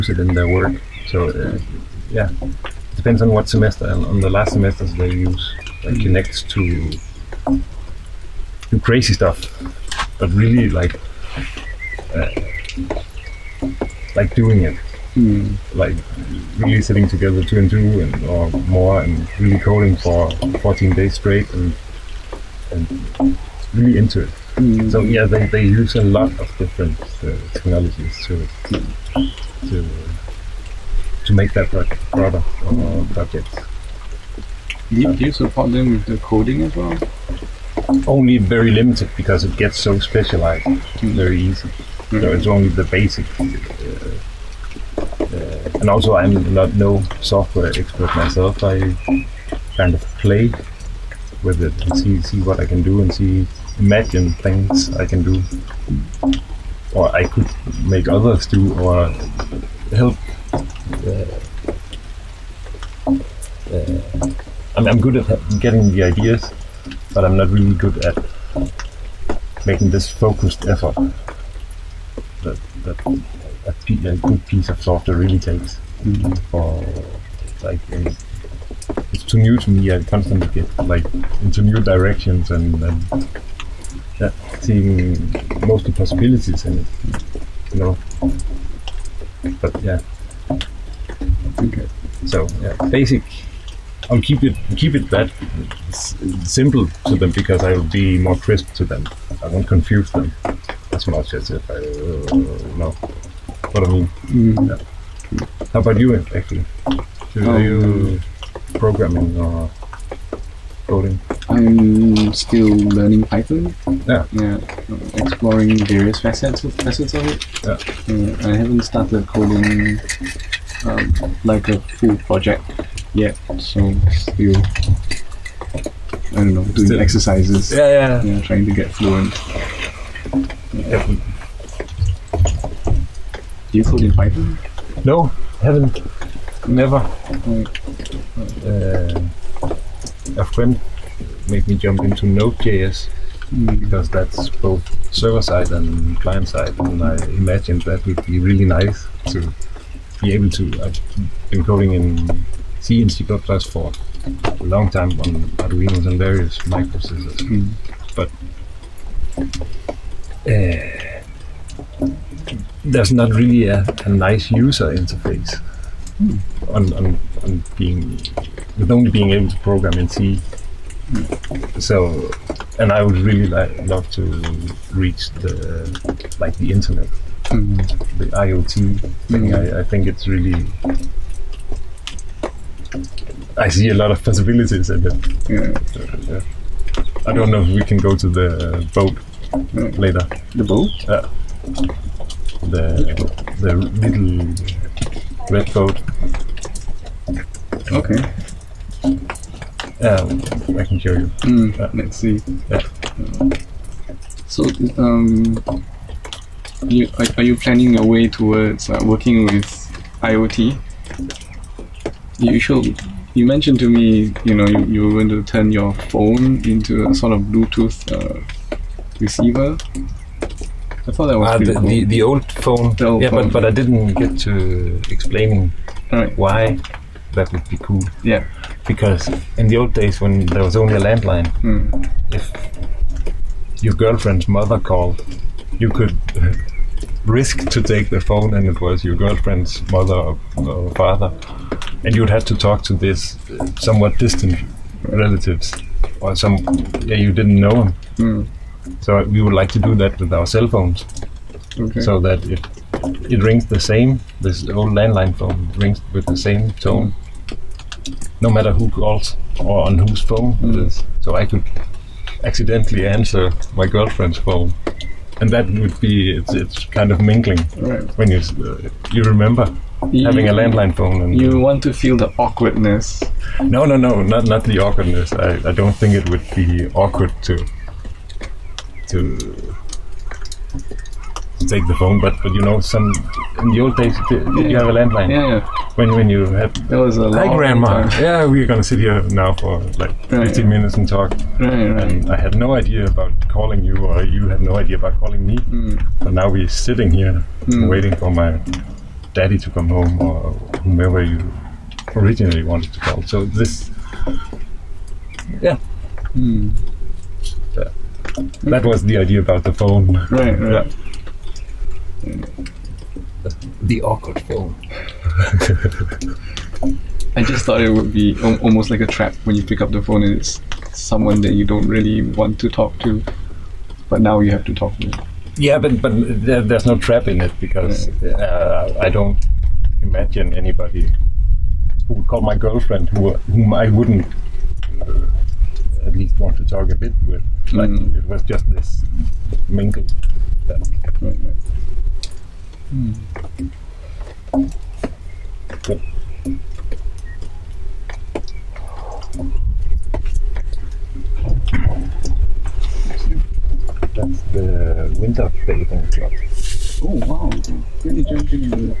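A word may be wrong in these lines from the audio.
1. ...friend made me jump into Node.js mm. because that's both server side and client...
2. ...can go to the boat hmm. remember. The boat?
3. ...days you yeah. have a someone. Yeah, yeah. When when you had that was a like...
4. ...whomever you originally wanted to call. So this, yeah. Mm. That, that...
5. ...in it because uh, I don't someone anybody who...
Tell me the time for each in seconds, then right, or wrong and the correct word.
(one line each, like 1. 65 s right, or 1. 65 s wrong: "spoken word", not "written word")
1. 140 s right
2. 187 s wrong: "later", not "remember"
3. 283 s wrong: "landline", not "someone"
4. 300 s right
5. 327 s wrong: "imagine", not "someone".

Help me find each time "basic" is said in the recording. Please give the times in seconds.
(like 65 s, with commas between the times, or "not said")
42 s, 92 s.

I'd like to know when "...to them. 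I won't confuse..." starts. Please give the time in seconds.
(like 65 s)
98 s.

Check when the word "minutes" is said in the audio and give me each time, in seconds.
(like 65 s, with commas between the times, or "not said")
290 s.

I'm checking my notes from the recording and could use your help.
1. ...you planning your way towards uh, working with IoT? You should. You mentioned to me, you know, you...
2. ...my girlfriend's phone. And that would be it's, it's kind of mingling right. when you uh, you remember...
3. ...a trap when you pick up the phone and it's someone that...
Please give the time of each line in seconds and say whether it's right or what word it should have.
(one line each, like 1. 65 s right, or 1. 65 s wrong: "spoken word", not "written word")
1. 207 s right
2. 263 s right
3. 319 s right.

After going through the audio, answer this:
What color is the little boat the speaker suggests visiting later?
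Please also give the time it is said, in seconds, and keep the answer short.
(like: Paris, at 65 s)
Red, at 195 s.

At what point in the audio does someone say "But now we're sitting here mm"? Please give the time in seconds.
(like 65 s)
296 s.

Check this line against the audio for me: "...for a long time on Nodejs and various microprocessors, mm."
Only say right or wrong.
wrong.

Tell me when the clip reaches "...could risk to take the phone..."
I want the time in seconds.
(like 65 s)
235 s.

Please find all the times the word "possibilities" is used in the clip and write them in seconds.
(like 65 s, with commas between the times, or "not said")
85 s, 184 s.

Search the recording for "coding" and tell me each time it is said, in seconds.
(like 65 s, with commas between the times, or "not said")
19 s, 36 s, 110 s, 119 s, 151 s.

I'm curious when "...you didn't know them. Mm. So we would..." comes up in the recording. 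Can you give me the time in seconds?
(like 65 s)
247 s.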